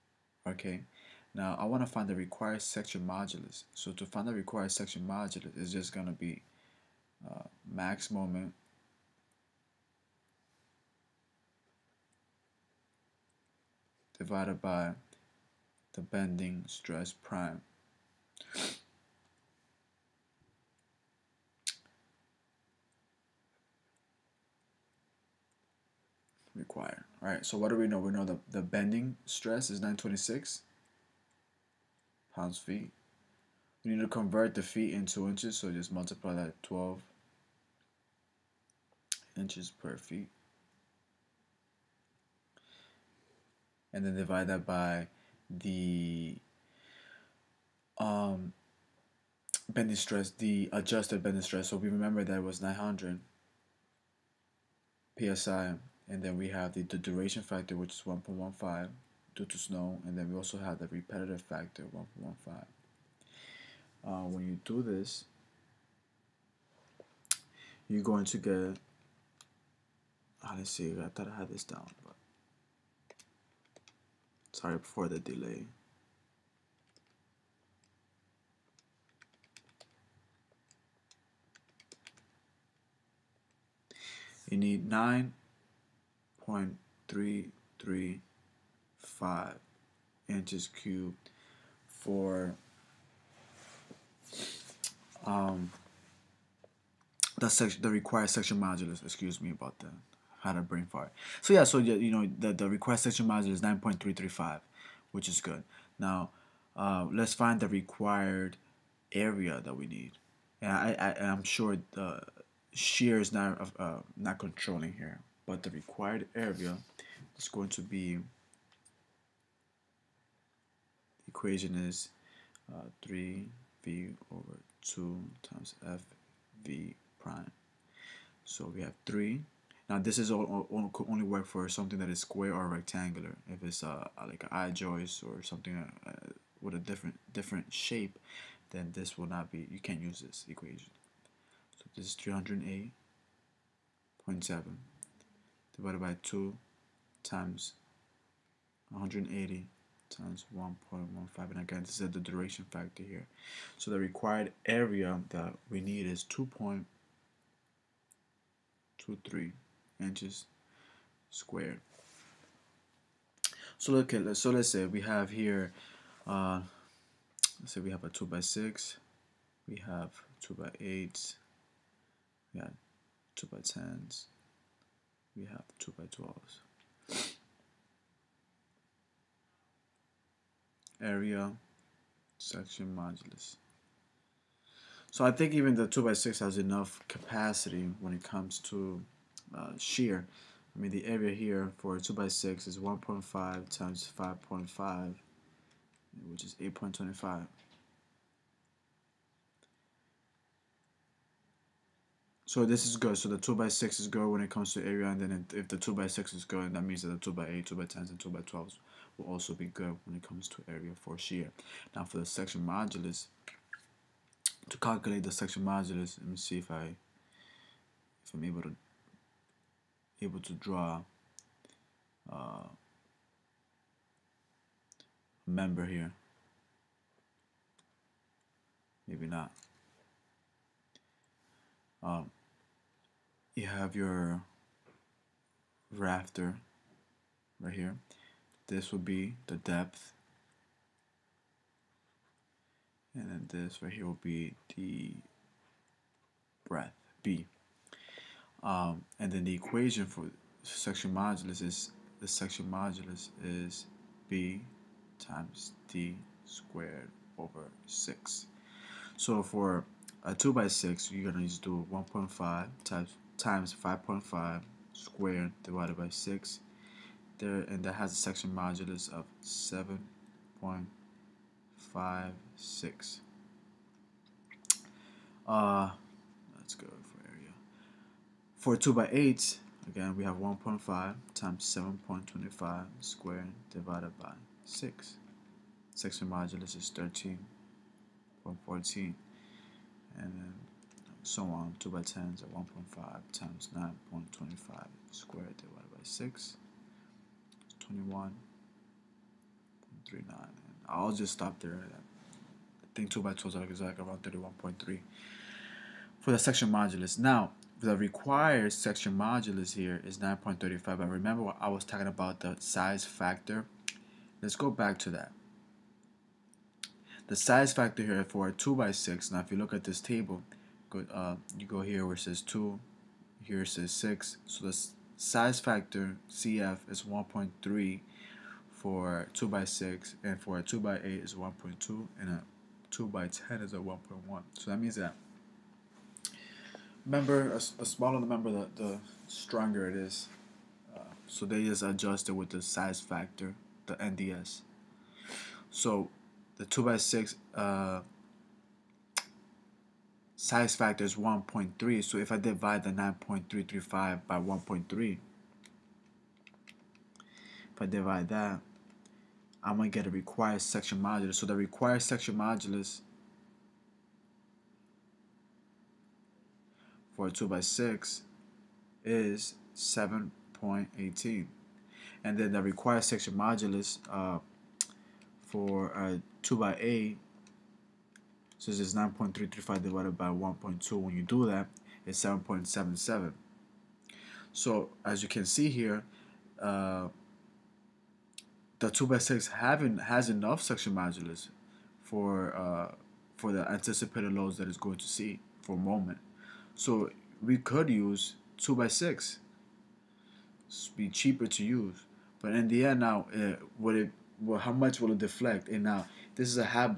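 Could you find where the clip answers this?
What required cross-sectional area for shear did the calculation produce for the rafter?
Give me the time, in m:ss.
2:36.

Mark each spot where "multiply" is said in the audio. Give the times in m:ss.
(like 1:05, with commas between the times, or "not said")
0:35.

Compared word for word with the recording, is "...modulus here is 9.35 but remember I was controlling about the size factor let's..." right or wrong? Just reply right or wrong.
wrong.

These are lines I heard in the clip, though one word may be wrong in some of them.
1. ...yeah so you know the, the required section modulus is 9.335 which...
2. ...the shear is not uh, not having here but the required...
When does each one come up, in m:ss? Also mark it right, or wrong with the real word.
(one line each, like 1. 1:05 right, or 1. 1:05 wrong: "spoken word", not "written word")
1. 1:41 right
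2. 1:51 wrong: "controlling", not "having".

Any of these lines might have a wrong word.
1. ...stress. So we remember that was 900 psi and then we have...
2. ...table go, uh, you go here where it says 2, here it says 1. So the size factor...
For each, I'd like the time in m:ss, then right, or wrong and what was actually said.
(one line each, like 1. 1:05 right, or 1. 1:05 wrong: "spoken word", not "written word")
1. 0:51 right
2. 5:20 wrong: "6", not "1".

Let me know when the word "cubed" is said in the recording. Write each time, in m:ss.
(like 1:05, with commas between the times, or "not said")
1:30.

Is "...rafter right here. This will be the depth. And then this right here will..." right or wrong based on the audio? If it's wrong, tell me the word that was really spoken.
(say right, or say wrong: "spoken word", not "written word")
right.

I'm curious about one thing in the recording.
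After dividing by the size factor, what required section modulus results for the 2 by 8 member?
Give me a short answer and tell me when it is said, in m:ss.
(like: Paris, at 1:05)
7.77, at 6:22.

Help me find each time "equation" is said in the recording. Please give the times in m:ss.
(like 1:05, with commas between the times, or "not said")
2:01, 2:20, 4:09.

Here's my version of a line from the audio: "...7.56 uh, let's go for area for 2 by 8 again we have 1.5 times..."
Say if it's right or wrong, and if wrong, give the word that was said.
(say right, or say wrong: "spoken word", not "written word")
right.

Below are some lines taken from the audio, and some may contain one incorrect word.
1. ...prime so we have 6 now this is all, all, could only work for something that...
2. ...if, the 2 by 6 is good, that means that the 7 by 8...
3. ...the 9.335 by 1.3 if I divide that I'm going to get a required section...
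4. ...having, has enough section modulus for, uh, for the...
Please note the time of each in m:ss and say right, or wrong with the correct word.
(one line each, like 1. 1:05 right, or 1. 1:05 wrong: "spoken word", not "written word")
1. 2:07 wrong: "3", not "6"
2. 3:25 wrong: "2", not "7"
3. 5:52 right
4. 6:29 right.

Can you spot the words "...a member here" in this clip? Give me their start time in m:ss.
3:45.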